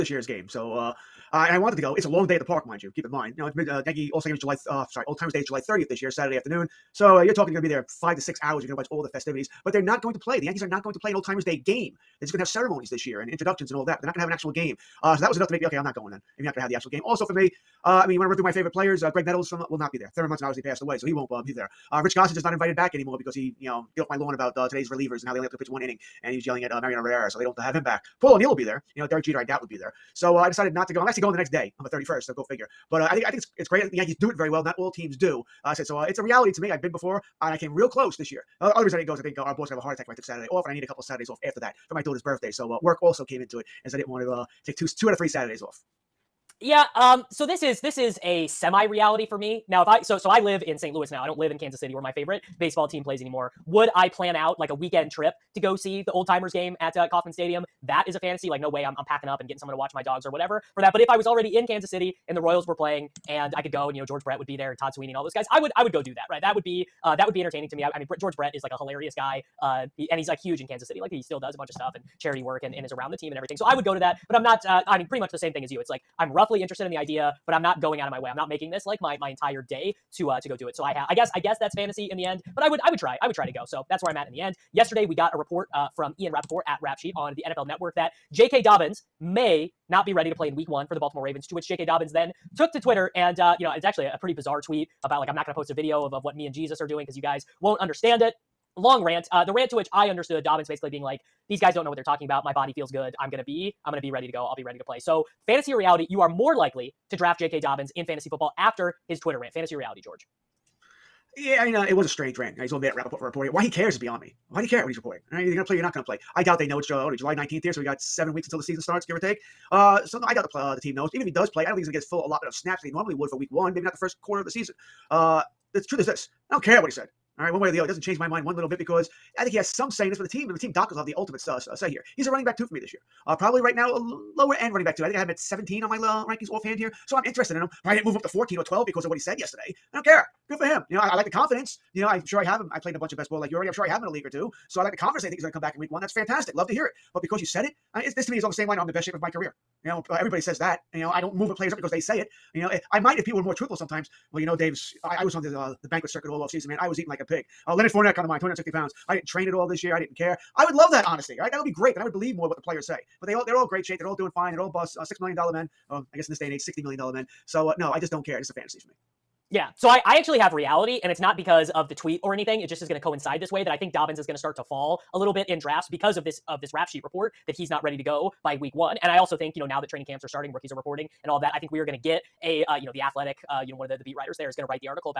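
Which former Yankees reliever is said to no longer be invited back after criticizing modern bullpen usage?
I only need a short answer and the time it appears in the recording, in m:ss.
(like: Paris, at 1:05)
Rich Gossage, at 0:22.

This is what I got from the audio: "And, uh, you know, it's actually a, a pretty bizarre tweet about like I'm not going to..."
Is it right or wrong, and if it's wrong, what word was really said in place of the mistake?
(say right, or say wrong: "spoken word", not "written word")
right.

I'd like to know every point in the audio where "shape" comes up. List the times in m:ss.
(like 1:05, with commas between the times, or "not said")
2:29, 2:43.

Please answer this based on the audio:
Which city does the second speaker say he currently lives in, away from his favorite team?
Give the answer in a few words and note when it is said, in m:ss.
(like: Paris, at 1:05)
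St. Louis, at 0:50.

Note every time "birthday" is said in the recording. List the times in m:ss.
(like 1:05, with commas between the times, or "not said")
0:42.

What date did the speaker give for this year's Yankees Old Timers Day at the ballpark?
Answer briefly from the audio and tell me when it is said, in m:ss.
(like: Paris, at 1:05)
July 30th, at 0:05.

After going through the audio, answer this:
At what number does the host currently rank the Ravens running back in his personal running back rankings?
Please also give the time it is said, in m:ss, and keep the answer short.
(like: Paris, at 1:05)
17, at 2:15.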